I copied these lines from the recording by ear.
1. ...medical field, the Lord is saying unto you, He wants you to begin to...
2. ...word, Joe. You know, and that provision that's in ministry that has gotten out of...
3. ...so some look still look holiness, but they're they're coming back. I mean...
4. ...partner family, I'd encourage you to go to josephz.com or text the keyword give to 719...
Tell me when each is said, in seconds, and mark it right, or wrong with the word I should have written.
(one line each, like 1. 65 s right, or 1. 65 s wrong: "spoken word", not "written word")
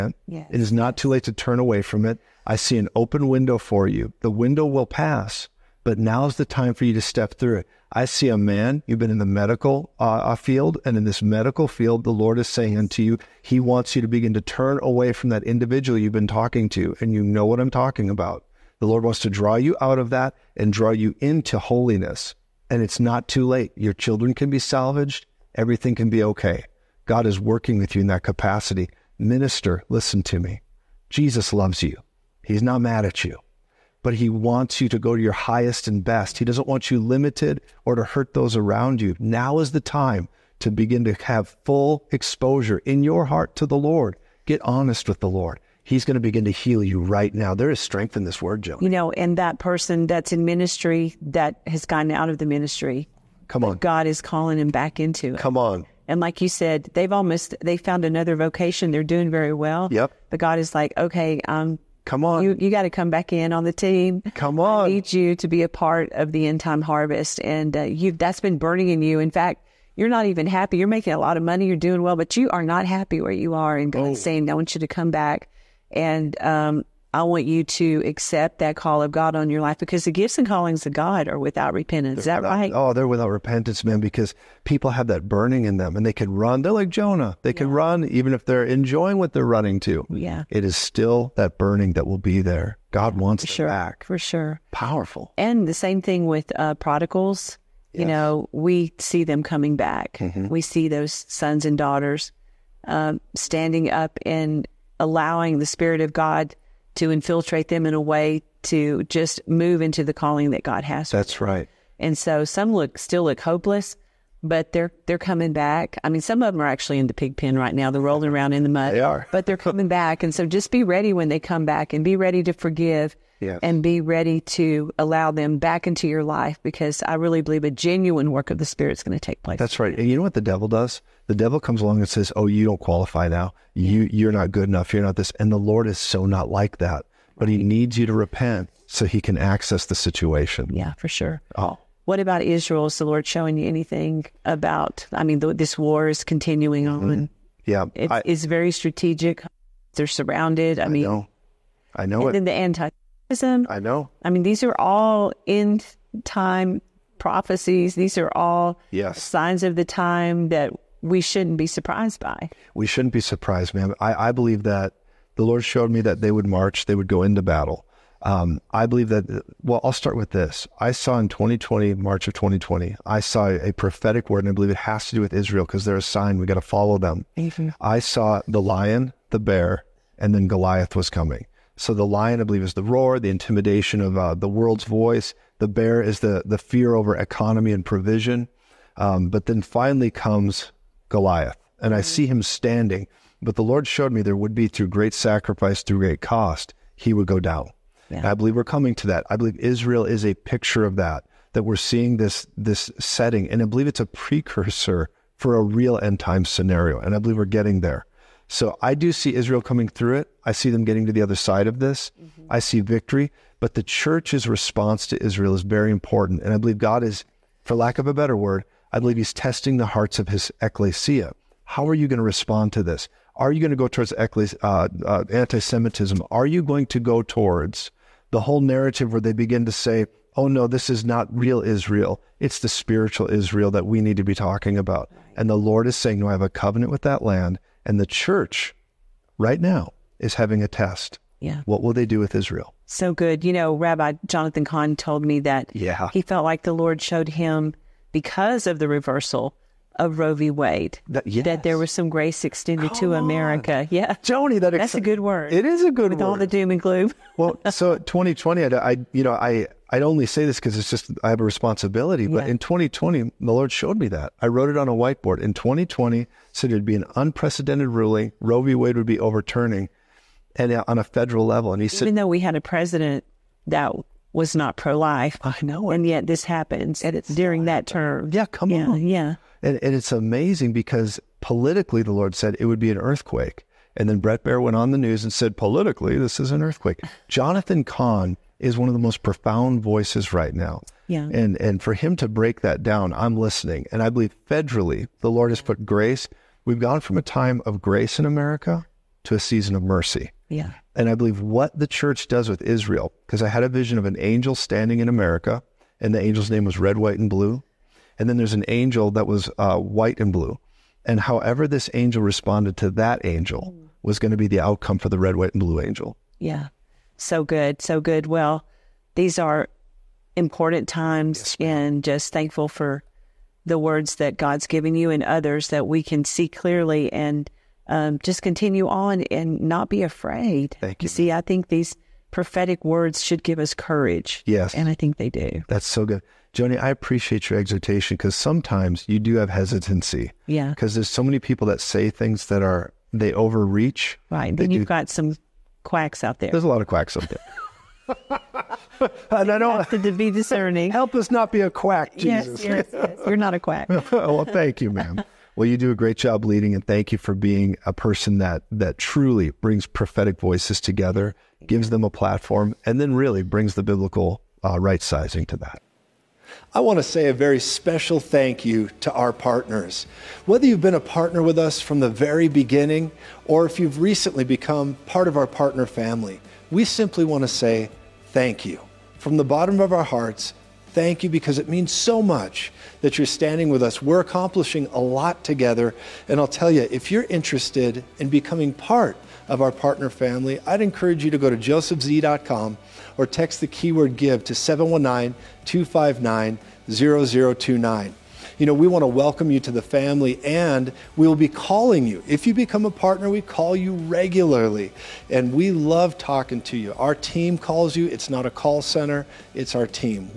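1. 11 s right
2. 48 s wrong: "person", not "provision"
3. 112 s wrong: "hopeless", not "holiness"
4. 389 s right.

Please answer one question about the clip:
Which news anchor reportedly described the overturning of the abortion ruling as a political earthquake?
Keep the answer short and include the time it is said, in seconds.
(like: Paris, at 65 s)
Bret Baier, at 284 s.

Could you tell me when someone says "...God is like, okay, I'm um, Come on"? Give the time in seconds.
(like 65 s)
60 s.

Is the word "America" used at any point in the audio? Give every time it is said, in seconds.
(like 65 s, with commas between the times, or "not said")
253 s, 298 s, 305 s.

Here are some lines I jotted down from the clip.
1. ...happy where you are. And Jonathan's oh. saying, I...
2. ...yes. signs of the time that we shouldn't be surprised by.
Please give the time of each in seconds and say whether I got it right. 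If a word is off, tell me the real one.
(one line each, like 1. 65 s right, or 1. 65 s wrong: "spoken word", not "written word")
1. 72 s wrong: "God", not "Jonathan"
2. 158 s right.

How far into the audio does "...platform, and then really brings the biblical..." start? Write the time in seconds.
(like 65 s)
362 s.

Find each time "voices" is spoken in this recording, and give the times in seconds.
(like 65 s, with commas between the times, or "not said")
184 s, 289 s, 360 s.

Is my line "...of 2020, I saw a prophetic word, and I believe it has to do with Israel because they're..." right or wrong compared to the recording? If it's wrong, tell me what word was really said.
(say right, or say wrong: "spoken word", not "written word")
right.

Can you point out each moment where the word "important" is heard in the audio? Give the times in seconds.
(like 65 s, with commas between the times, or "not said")
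215 s, 320 s.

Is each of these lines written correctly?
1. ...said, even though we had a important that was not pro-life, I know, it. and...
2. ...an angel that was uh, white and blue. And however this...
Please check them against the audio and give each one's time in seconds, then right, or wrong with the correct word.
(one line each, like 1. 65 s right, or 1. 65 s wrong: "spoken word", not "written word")
1. 271 s wrong: "president", not "important"
2. 308 s right.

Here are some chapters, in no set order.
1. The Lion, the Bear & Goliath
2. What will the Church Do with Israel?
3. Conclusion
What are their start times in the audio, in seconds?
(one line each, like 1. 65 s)
1. 158 s
2. 223 s
3. 323 s.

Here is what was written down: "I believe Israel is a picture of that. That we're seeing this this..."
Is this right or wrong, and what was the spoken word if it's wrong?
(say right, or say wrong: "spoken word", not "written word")
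right.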